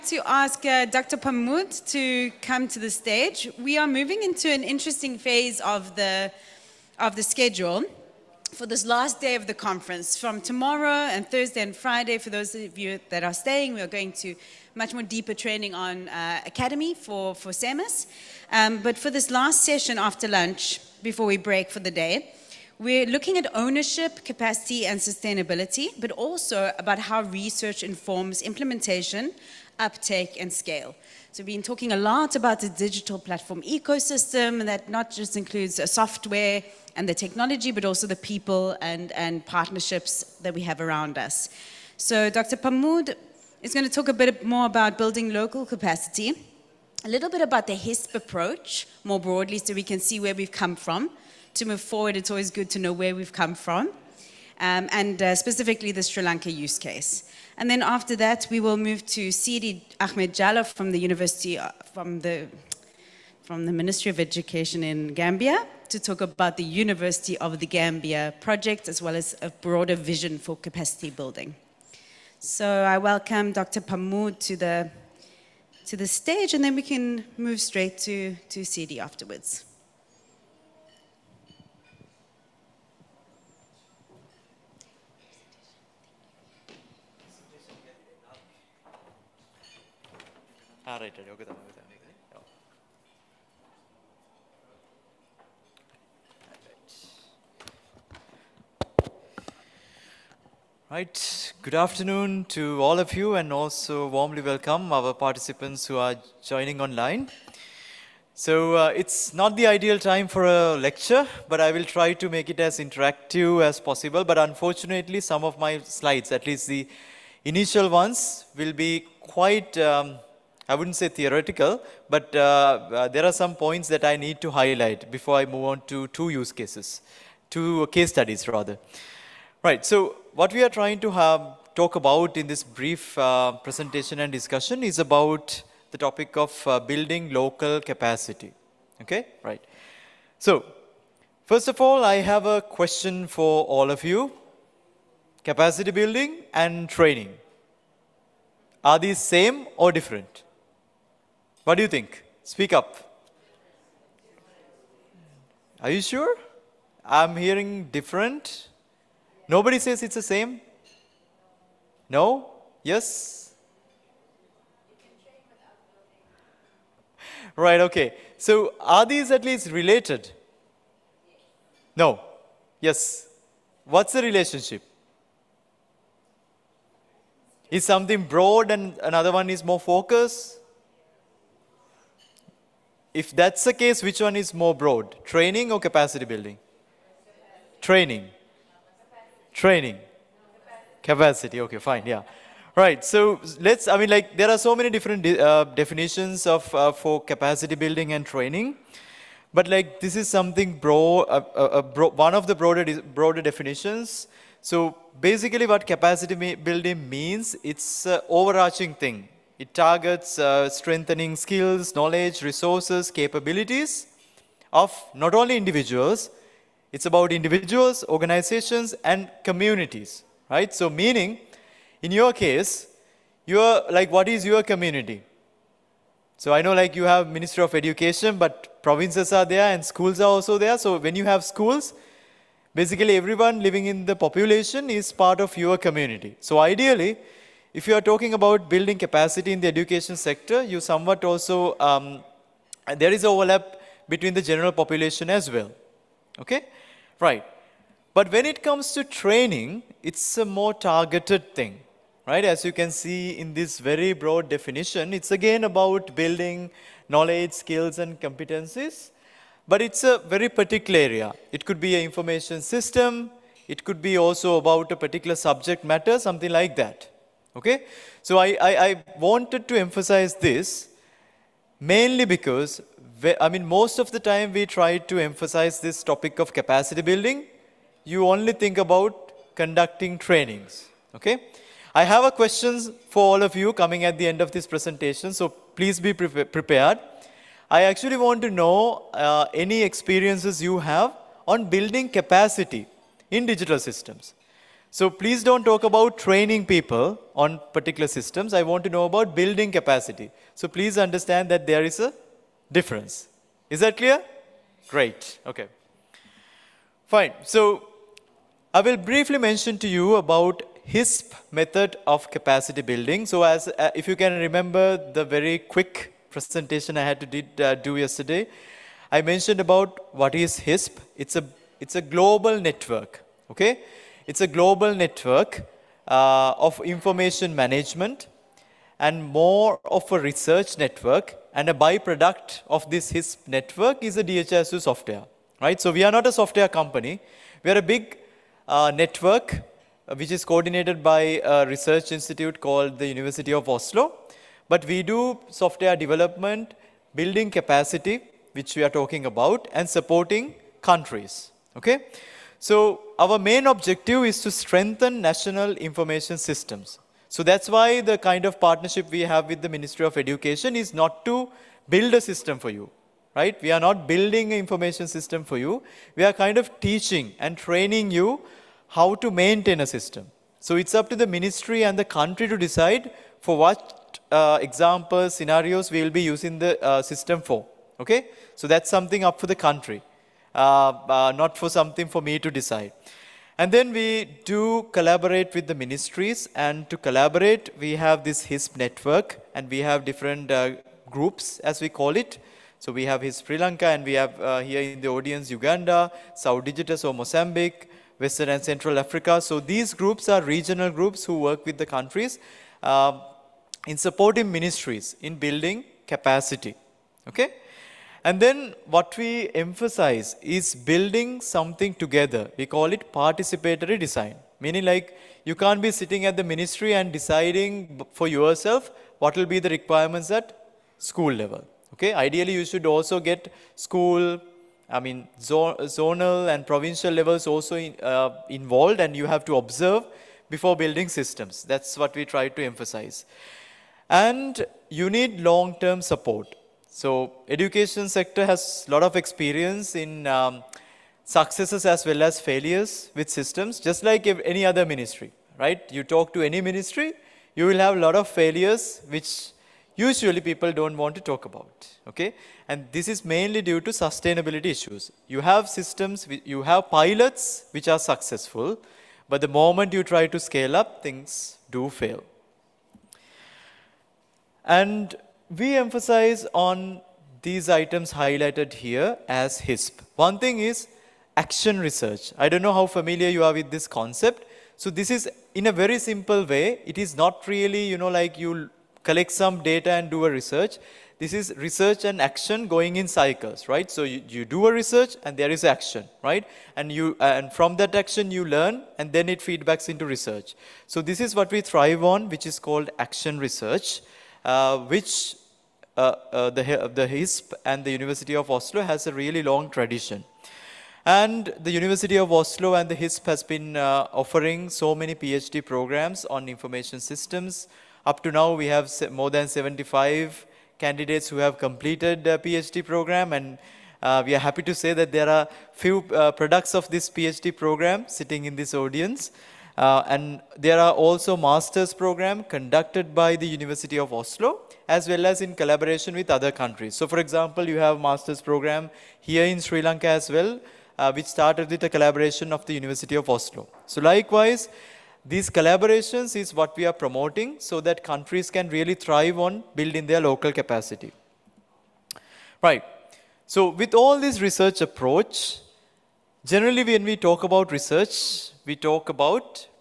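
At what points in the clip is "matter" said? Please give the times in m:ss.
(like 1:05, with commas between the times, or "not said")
4:25.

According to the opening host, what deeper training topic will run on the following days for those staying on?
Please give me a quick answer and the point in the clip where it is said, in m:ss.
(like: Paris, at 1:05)
Academy, at 0:16.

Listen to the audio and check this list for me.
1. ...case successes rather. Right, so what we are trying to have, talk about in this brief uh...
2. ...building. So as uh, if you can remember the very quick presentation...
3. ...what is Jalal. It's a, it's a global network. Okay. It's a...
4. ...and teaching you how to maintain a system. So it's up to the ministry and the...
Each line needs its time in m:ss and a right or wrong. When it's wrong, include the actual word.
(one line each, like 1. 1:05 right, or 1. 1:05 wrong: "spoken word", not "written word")
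1. 2:07 wrong: "studies", not "successes"
2. 5:12 right
3. 5:20 wrong: "HISP", not "Jalal"
4. 6:07 wrong: "training", not "teaching".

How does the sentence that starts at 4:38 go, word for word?
You only think about conducting trainings.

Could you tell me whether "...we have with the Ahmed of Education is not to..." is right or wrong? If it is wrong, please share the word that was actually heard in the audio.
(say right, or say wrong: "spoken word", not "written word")
wrong: "Ministry", not "Ahmed".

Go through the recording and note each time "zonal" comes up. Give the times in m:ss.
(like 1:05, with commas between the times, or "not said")
7:05.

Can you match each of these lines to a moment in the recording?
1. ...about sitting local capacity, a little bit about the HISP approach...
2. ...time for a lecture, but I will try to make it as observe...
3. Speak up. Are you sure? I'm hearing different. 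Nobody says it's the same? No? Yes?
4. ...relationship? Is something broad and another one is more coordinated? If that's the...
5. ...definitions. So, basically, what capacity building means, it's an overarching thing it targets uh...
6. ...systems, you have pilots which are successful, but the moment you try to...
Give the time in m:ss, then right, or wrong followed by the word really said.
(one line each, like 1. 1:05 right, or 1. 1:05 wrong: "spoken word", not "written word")
1. 0:44 wrong: "building", not "sitting"
2. 1:49 wrong: "interactive", not "observe"
3. 2:32 right
4. 2:54 wrong: "focused", not "coordinated"
5. 3:23 right
6. 7:35 right.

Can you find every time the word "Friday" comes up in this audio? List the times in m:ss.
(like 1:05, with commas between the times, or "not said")
0:11.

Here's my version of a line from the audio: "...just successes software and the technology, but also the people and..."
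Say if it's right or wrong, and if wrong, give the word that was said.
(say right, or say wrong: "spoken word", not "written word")
wrong: "includes", not "successes".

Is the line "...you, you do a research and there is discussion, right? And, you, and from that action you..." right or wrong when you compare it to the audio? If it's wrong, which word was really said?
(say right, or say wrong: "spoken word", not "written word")
wrong: "action", not "discussion".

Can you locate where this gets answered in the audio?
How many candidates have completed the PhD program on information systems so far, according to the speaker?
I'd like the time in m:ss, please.
8:29.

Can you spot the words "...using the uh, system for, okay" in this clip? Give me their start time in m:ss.
6:16.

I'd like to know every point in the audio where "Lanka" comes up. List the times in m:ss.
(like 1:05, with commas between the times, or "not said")
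0:56, 6:33, 8:49.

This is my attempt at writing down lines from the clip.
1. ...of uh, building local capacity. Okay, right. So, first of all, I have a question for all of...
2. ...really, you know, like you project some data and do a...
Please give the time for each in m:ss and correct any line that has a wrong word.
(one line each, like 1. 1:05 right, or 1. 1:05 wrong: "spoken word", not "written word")
1. 2:16 right
2. 7:57 wrong: "collect", not "project".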